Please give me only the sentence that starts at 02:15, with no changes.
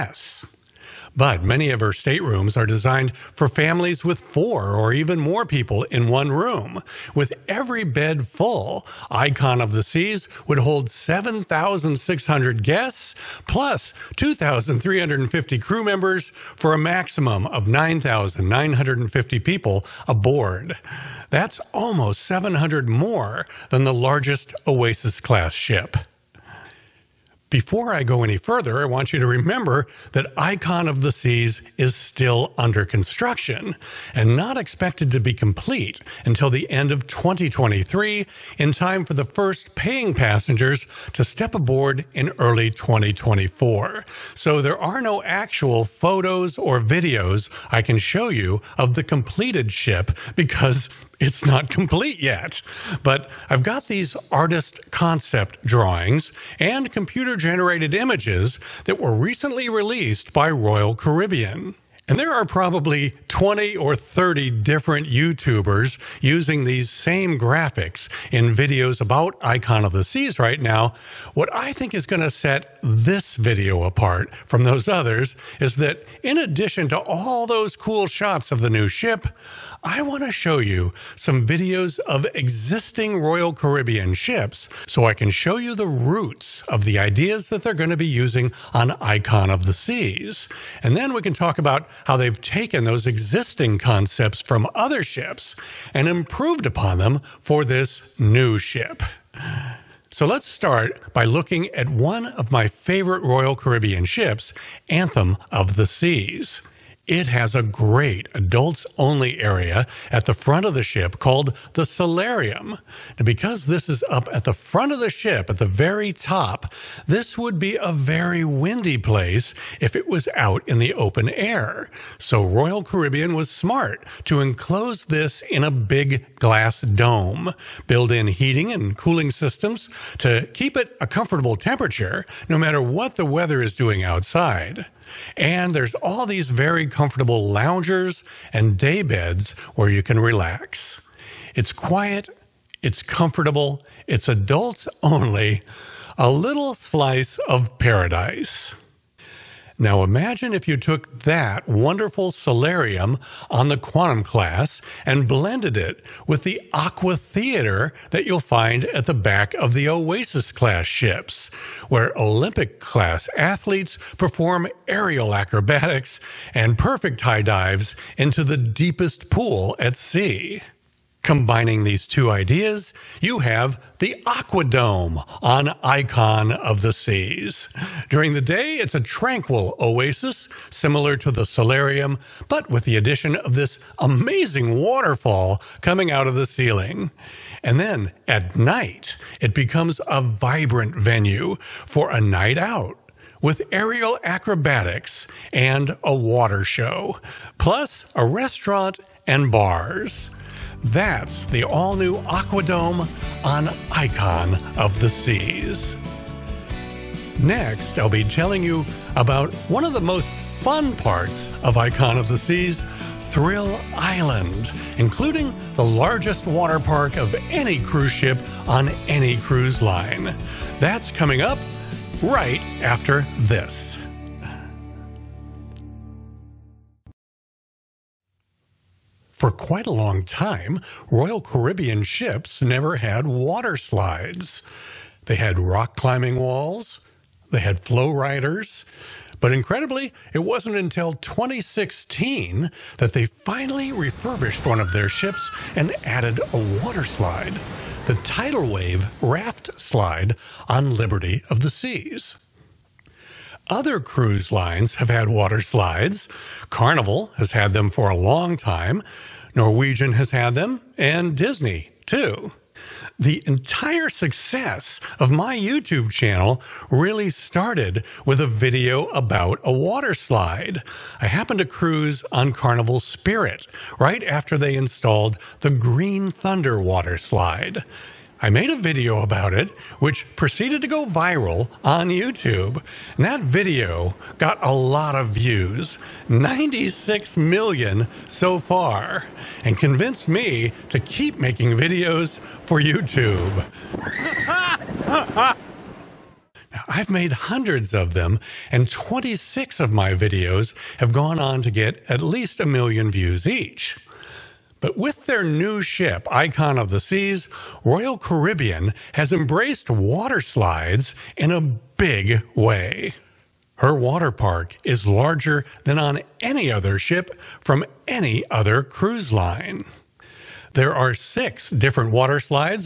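And there's all these very comfortable loungers and day beds where you can relax.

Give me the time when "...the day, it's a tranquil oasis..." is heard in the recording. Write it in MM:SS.
02:58.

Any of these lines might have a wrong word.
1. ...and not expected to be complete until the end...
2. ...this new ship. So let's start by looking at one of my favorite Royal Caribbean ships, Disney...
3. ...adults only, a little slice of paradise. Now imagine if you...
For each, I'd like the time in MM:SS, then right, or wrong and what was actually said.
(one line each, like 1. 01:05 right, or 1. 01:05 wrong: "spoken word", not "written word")
1. 00:34 right
2. 01:37 wrong: "Anthem", not "Disney"
3. 02:24 right.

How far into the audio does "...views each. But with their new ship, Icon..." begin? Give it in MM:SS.
05:03.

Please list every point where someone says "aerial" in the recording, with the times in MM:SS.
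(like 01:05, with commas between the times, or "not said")
02:44, 03:13.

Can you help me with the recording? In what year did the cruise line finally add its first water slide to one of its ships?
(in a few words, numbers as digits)
2016.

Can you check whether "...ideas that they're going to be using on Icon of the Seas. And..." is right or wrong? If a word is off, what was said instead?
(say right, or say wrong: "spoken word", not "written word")
right.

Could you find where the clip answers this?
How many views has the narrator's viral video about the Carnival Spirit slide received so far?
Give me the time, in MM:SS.
04:46.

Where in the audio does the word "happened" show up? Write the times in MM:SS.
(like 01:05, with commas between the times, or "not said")
04:31.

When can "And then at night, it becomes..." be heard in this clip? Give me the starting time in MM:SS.
03:07.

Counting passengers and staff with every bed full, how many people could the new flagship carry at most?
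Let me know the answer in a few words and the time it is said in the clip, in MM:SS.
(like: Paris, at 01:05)
9,950, at 00:17.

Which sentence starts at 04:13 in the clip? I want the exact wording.
Other cruise lines have had water slides.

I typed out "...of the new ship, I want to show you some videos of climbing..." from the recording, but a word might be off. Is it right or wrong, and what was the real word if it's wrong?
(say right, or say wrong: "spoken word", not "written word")
wrong: "existing", not "climbing".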